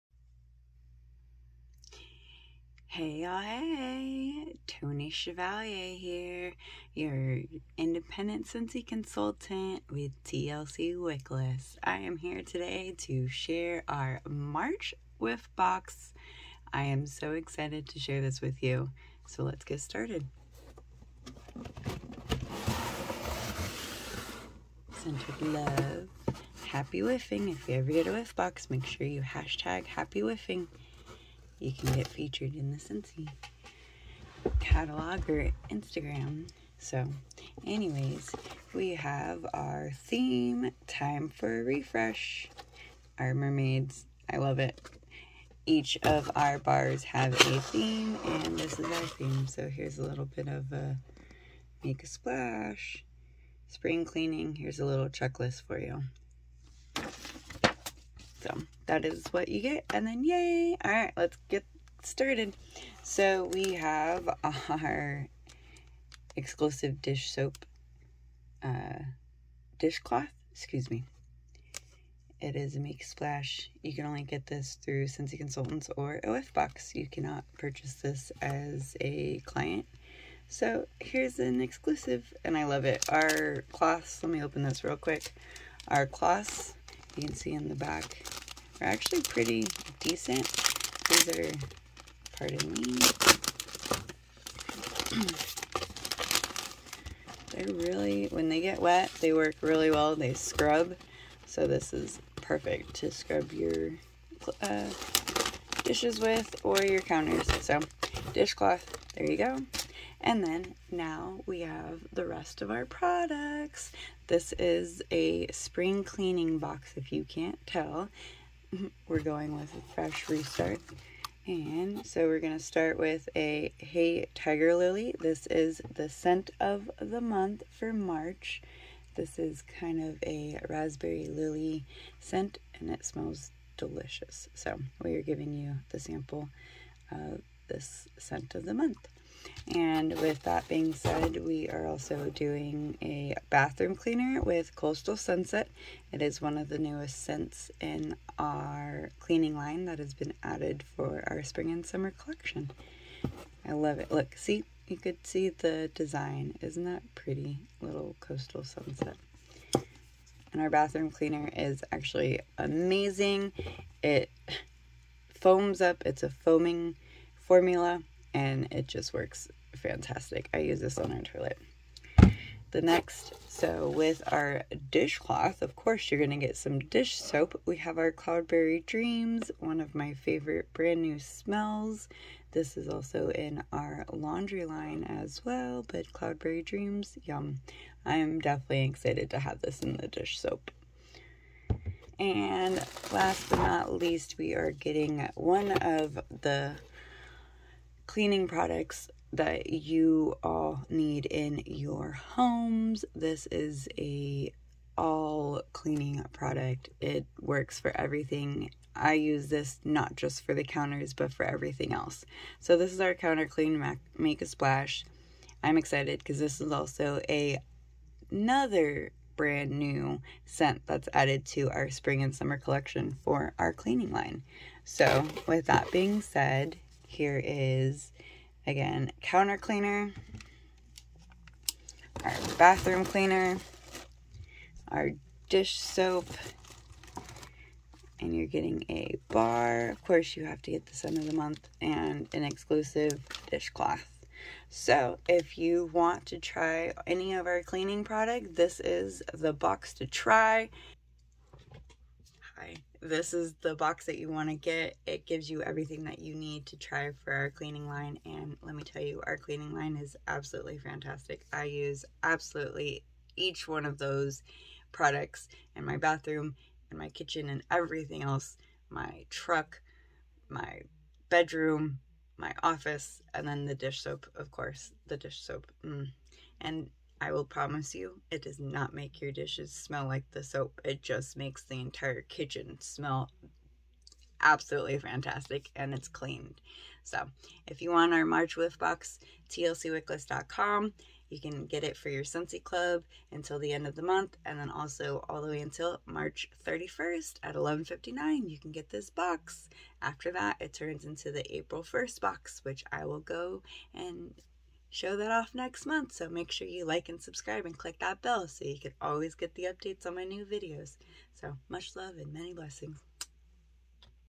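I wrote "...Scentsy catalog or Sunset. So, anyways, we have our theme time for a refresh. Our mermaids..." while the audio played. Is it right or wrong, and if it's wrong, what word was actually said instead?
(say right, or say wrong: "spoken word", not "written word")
wrong: "Instagram", not "Sunset".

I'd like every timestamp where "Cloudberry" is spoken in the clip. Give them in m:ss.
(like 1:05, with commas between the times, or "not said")
2:58, 3:06.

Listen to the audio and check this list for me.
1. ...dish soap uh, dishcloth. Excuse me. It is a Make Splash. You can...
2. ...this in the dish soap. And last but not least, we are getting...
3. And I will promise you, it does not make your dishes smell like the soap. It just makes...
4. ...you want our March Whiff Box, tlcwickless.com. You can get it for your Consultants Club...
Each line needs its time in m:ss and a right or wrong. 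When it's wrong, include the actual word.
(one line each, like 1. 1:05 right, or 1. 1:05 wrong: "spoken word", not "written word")
1. 1:07 right
2. 3:09 right
3. 4:36 right
4. 4:47 wrong: "Scentsy", not "Consultants".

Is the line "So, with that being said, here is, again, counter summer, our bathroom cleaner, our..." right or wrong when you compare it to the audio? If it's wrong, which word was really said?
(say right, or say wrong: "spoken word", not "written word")
wrong: "cleaner", not "summer".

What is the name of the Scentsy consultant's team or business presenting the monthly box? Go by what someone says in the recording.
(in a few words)
TLC Wickless.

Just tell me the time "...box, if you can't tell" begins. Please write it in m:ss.
1:56.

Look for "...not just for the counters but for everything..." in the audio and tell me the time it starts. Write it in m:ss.
3:29.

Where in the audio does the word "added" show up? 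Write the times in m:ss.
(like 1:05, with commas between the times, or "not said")
2:30, 3:41.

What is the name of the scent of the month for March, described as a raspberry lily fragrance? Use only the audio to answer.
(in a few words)
Hey Tiger Lily.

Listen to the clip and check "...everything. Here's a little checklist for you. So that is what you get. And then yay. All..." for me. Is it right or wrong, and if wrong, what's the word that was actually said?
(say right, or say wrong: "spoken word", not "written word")
wrong: "cleaning", not "everything".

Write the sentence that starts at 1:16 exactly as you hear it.
You cannot purchase this as a client.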